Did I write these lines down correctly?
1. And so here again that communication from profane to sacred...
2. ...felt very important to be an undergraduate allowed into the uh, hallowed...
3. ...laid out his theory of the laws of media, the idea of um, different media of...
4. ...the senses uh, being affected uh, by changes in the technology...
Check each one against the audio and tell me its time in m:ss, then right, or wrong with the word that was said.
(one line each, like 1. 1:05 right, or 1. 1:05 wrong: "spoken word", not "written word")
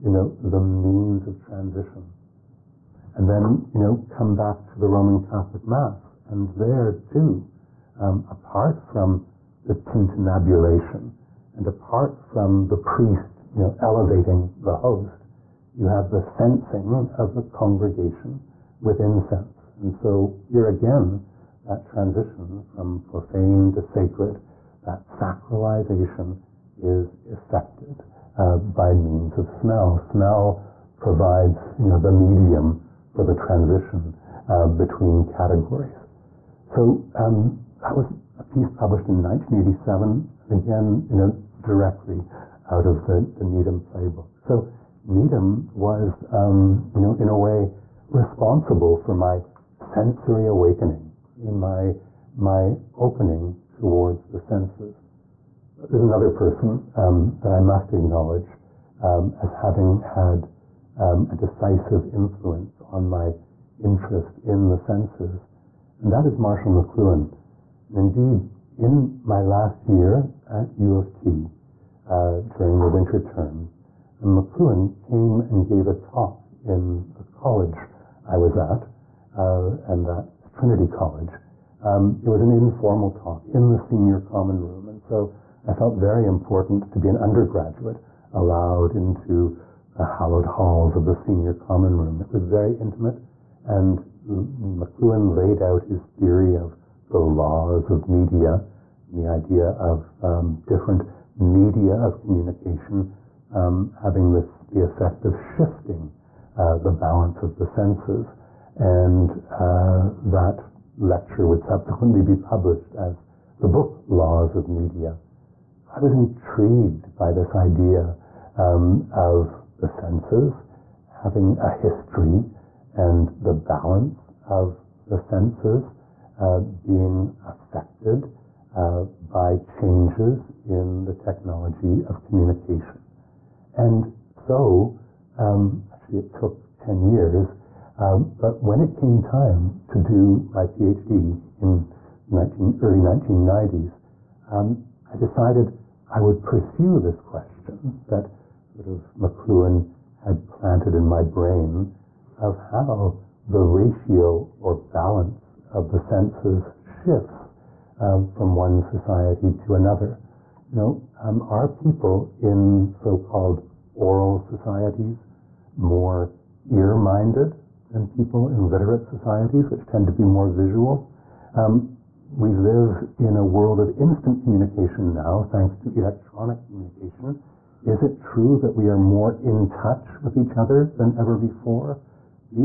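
1. 0:19 wrong: "transition", not "communication"
2. 1:25 right
3. 1:35 right
4. 2:05 right.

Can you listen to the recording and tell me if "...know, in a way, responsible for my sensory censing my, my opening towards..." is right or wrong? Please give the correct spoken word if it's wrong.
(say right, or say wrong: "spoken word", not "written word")
wrong: "awakening", not "censing".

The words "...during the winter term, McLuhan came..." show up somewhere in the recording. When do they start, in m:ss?
1:12.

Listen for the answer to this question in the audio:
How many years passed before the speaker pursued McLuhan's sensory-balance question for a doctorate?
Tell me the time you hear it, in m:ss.
2:16.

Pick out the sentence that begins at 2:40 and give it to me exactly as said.
You know, um, are people in so-called oral societies more ear-minded than people in literate societies, which tend to be more visual.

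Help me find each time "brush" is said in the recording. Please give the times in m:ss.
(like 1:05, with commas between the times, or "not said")
not said.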